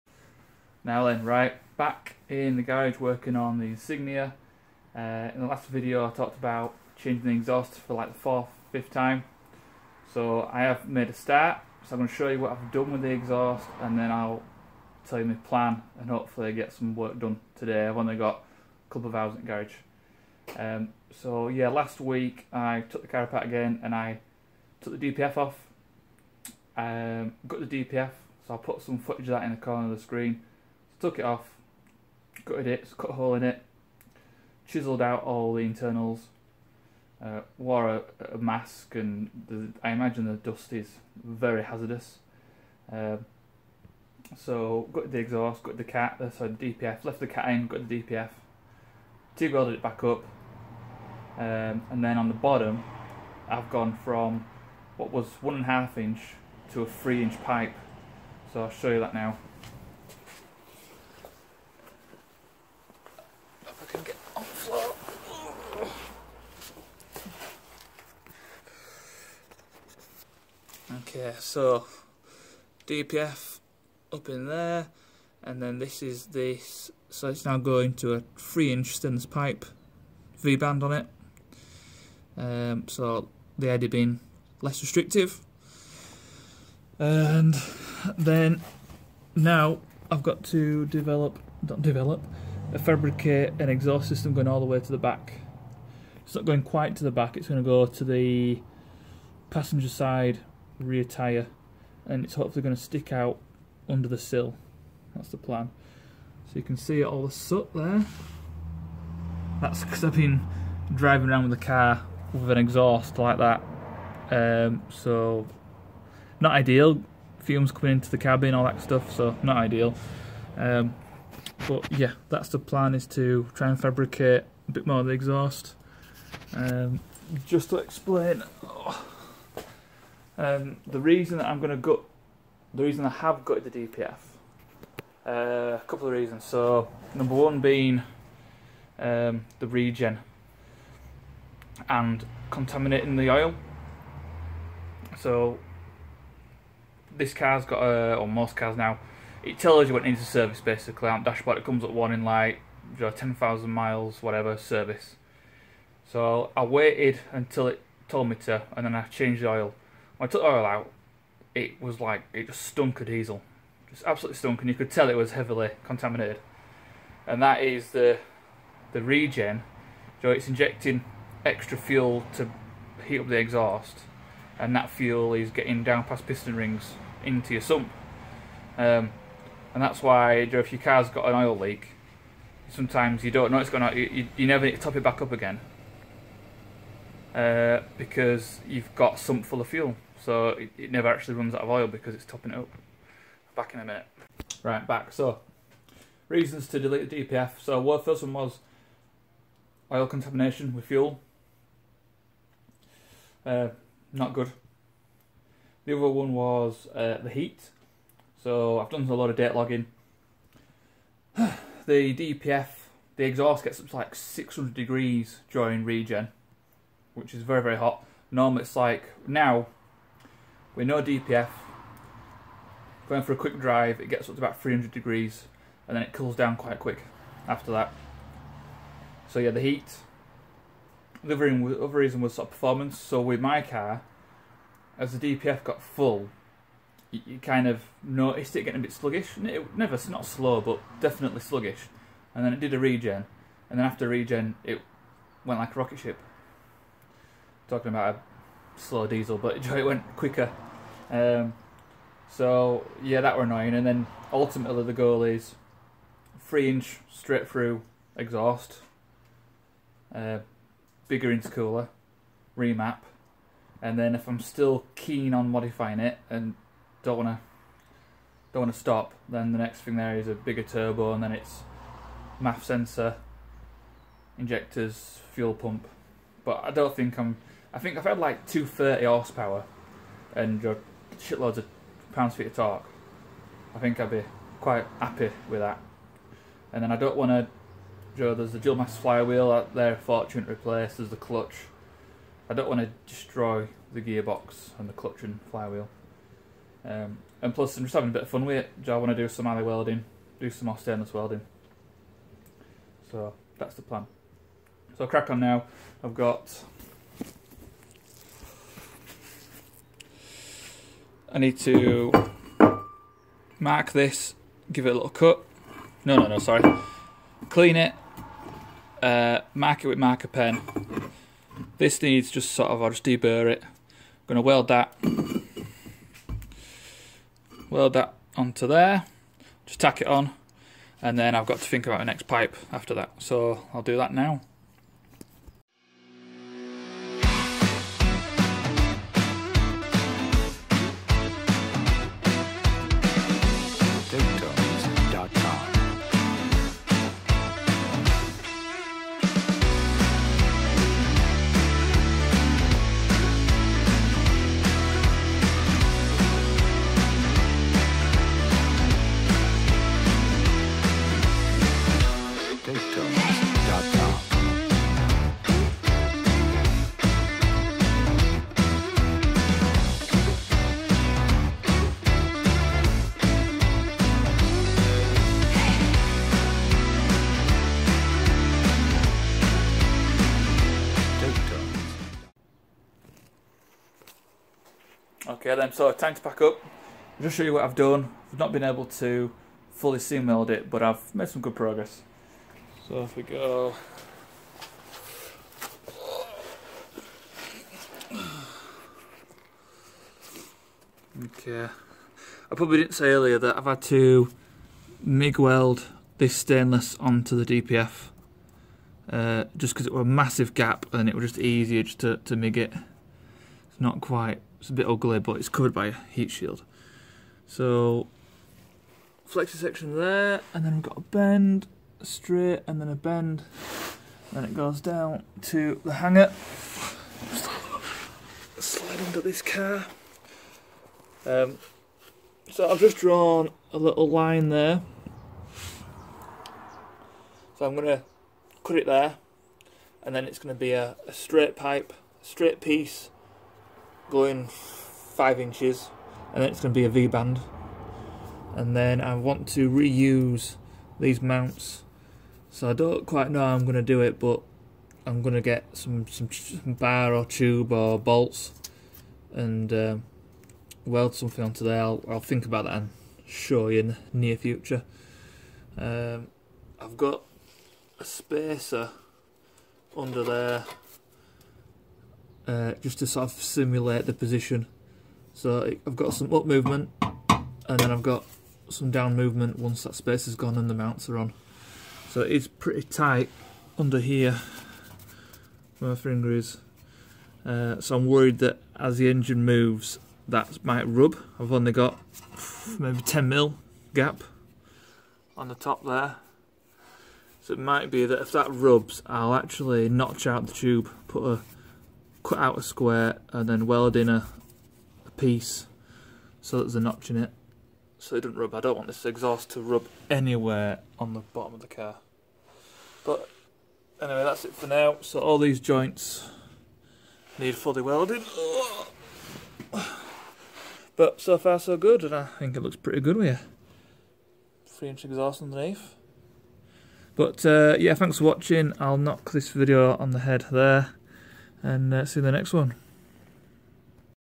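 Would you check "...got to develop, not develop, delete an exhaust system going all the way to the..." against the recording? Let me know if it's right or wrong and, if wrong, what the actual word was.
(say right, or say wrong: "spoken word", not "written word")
wrong: "fabricate", not "delete".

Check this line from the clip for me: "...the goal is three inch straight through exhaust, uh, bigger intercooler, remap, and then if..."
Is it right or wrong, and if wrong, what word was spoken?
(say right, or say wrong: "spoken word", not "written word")
right.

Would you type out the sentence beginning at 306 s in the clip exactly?
I've got I need to mark this, give it a little cut.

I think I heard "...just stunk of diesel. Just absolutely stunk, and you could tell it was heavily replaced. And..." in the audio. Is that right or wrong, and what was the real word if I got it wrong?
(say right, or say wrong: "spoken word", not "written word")
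wrong: "contaminated", not "replaced".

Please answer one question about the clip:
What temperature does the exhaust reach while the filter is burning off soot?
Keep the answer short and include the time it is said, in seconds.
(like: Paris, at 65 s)
600 degrees, at 214 s.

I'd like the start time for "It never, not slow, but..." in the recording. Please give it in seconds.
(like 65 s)
239 s.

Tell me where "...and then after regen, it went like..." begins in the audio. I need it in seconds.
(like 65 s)
243 s.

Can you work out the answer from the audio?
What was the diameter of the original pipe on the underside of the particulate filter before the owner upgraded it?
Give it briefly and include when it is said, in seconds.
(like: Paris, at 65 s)
1.5 inch, at 55 s.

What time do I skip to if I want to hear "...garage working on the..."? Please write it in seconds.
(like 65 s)
2 s.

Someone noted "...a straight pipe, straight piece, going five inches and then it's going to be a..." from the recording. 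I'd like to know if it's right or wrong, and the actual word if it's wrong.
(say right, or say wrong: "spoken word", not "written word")
right.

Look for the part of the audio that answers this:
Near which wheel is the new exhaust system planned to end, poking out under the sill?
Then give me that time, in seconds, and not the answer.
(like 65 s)
99 s.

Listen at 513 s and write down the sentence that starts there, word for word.
But anyway, that's it for now.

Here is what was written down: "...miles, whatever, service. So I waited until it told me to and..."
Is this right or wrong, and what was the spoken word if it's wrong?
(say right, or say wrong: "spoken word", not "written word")
right.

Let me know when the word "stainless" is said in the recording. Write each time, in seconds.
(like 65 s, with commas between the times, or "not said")
78 s, 300 s, 406 s.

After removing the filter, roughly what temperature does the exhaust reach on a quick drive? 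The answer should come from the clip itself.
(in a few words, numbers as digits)
300 degrees.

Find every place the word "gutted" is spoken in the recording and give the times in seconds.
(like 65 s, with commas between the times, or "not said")
32 s, 133 s.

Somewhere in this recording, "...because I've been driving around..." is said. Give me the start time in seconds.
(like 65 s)
109 s.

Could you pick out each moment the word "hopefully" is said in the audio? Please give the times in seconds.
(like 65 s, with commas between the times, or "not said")
16 s, 102 s.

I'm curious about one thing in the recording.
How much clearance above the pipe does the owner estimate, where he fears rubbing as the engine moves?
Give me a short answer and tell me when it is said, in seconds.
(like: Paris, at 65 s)
10 mil, at 493 s.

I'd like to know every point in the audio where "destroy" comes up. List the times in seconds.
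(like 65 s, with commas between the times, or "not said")
293 s.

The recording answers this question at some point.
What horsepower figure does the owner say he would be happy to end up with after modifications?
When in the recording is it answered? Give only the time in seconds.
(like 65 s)
278 s.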